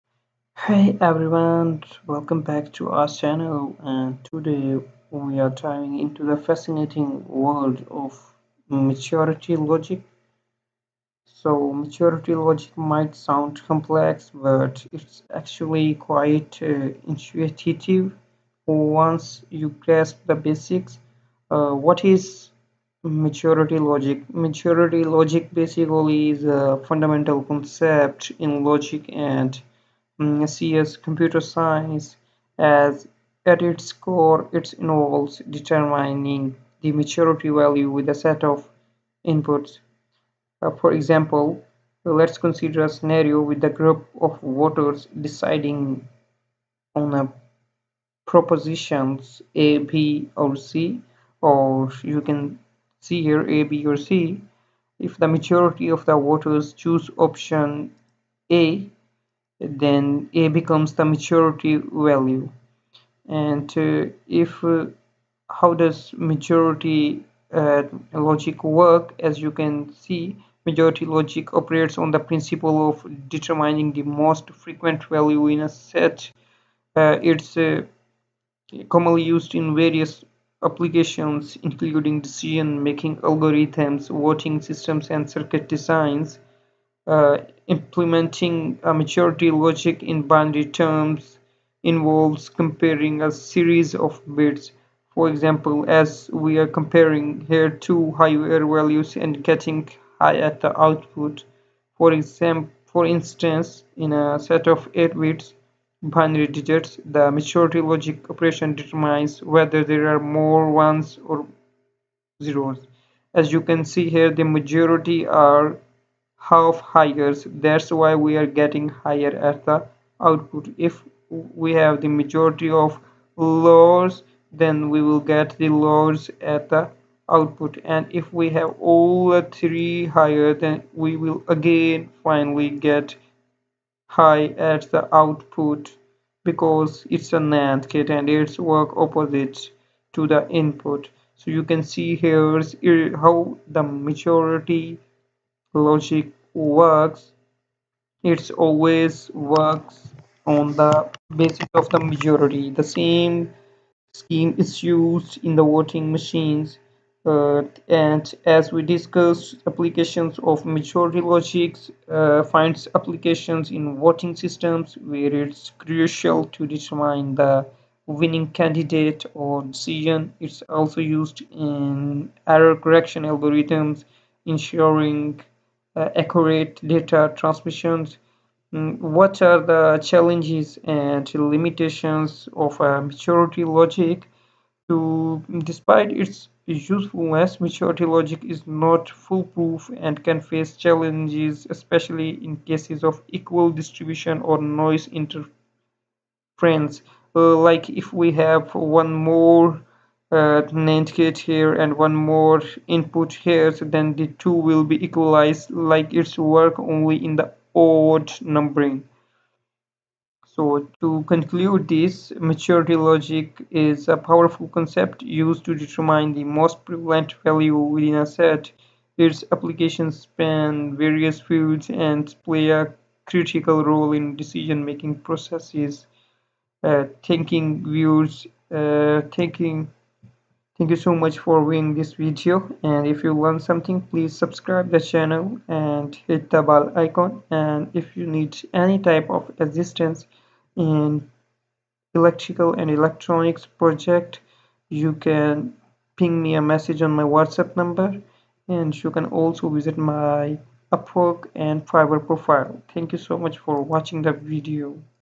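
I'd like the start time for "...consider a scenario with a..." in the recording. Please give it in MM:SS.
00:42.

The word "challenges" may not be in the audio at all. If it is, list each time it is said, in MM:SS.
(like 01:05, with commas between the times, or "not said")
03:00, 03:10.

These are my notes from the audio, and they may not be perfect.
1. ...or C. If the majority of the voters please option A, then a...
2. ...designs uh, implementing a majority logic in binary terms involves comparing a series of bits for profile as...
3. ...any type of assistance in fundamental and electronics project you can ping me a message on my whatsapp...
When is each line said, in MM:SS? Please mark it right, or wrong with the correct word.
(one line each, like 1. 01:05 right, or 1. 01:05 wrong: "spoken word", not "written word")
1. 00:53 wrong: "choose", not "please"
2. 01:25 wrong: "example", not "profile"
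3. 03:58 wrong: "electrical", not "fundamental".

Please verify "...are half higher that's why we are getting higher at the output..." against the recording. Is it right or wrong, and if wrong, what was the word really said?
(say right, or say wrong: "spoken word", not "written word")
right.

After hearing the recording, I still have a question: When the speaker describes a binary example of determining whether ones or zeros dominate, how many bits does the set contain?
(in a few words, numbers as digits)
8.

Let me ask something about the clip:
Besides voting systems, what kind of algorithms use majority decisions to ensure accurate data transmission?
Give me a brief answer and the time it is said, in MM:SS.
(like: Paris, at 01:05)
Error correction algorithms, at 02:52.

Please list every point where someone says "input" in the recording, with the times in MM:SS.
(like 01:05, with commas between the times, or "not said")
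00:39, 02:20, 03:22.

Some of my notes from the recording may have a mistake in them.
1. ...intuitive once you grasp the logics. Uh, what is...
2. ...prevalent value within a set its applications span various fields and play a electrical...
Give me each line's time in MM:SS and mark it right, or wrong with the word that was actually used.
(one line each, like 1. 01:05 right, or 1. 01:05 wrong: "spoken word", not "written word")
1. 00:17 wrong: "basics", not "logics"
2. 03:36 wrong: "critical", not "electrical".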